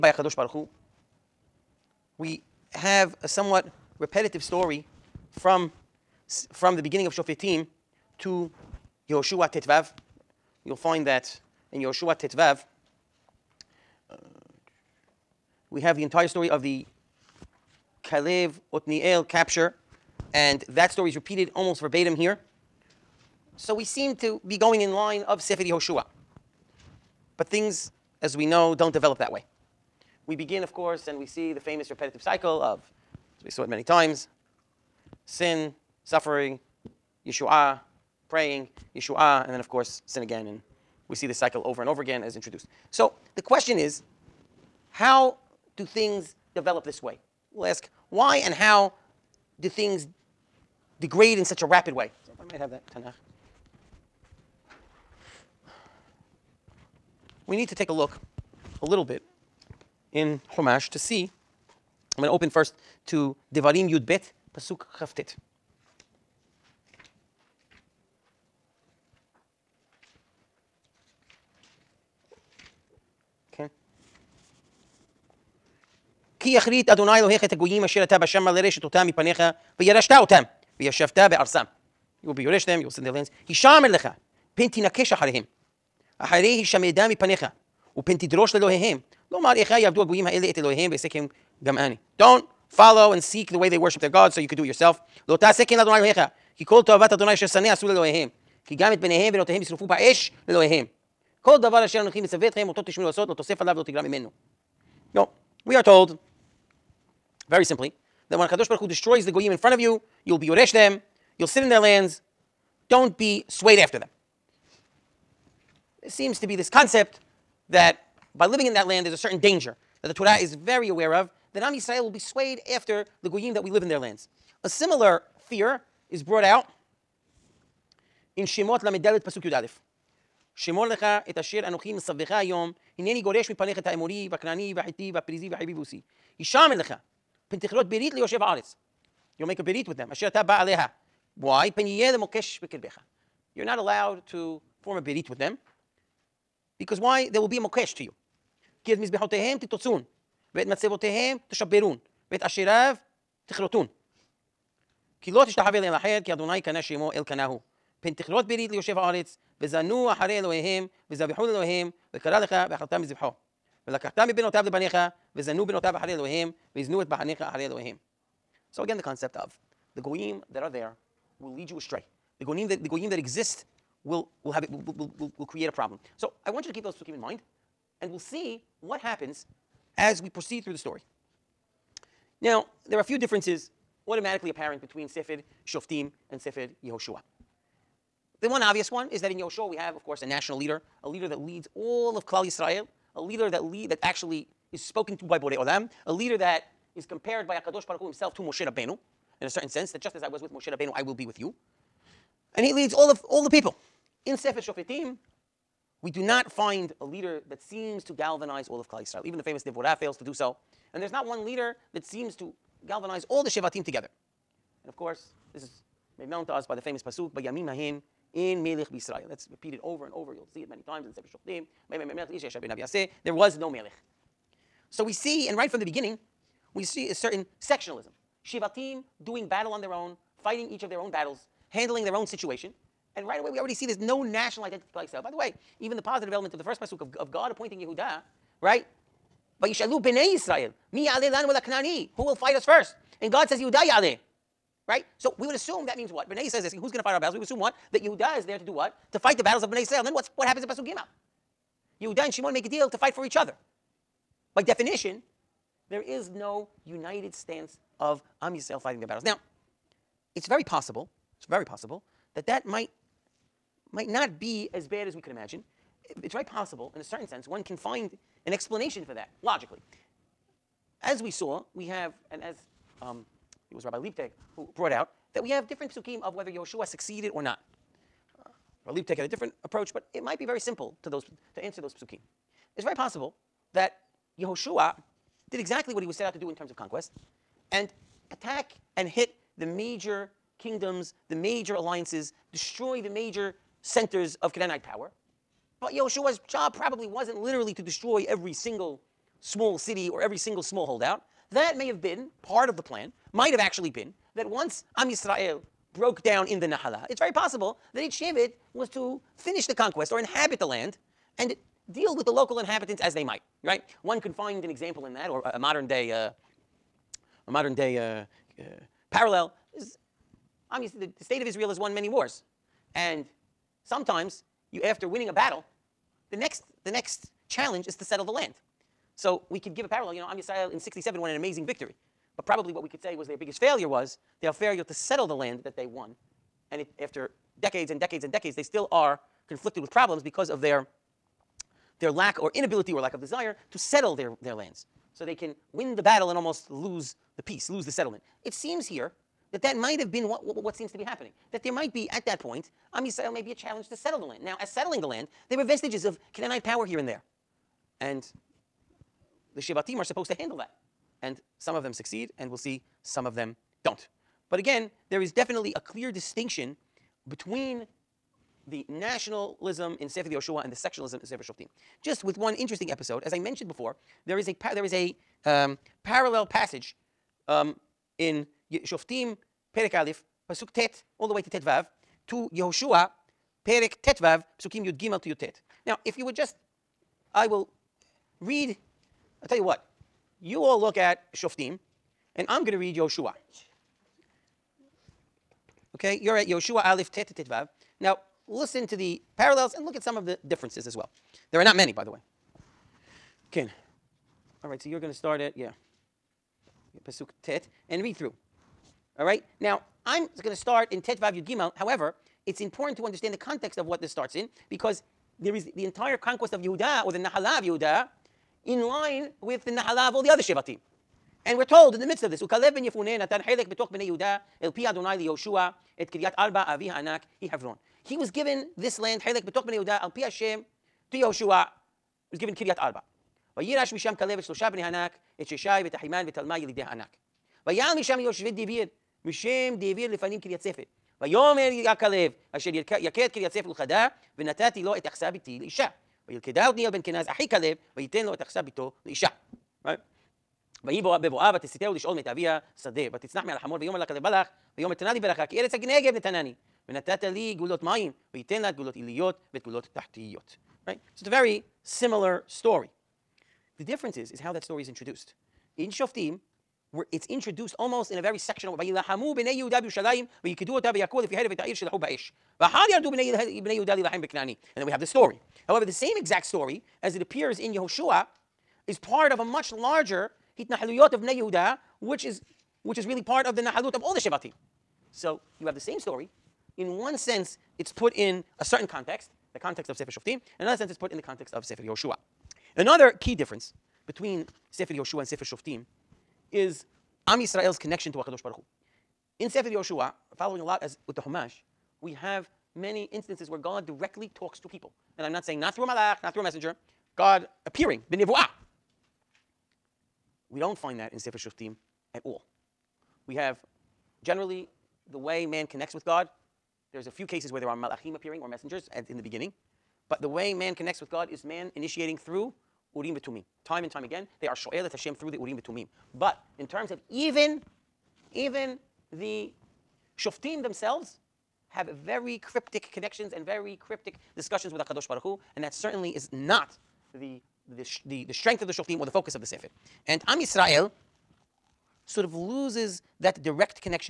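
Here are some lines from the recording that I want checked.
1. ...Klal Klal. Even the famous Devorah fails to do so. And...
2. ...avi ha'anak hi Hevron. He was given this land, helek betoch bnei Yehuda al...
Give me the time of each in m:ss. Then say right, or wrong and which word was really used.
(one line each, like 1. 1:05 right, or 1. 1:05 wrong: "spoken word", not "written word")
1. 3:28 wrong: "Yisrael", not "Klal"
2. 7:06 right.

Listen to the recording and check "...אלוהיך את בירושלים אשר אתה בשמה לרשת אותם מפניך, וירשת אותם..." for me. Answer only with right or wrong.
wrong.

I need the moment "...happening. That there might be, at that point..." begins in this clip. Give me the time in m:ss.
5:51.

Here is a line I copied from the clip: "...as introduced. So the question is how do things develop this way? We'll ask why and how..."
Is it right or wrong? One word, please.
right.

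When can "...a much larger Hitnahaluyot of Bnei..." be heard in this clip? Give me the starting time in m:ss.
7:59.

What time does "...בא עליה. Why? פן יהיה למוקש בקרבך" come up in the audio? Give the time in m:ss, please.
2:20.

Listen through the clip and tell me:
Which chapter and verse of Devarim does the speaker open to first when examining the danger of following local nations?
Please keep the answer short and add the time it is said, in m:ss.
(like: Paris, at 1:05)
Devarim 12:9, at 1:03.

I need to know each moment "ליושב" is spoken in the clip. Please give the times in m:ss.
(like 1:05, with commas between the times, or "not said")
2:18, 2:38.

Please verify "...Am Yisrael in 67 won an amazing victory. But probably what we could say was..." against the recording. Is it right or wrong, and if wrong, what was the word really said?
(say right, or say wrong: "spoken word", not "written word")
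right.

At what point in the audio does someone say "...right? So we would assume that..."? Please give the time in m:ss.
4:04.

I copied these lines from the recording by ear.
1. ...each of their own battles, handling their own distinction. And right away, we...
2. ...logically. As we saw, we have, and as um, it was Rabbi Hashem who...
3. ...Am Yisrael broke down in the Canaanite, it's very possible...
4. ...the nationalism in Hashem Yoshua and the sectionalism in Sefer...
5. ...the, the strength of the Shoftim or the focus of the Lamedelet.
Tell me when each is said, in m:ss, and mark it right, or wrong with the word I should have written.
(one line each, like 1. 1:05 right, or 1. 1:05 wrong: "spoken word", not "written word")
1. 3:50 wrong: "situation", not "distinction"
2. 4:29 wrong: "Leibtag", not "Hashem"
3. 5:04 wrong: "Nahala", not "Canaanite"
4. 6:08 wrong: "Sefer", not "Hashem"
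5. 8:58 wrong: "Sefer", not "Lamedelet".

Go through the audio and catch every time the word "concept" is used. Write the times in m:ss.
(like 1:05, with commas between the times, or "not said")
1:56, 2:49.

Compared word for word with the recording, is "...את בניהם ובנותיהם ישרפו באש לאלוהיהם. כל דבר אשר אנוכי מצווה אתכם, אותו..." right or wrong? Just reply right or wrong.
right.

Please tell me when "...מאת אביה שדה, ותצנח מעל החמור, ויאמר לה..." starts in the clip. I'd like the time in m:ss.
7:32.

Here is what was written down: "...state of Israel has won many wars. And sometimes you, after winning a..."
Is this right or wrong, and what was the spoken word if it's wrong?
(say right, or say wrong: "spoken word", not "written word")
right.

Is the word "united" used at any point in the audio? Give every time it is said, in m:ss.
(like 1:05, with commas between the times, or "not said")
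4:16.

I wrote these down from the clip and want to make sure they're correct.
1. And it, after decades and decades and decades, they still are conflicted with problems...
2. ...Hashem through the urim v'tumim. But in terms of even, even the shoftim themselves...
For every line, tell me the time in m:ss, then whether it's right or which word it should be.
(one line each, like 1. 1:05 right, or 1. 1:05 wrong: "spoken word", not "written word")
1. 5:36 right
2. 8:44 right.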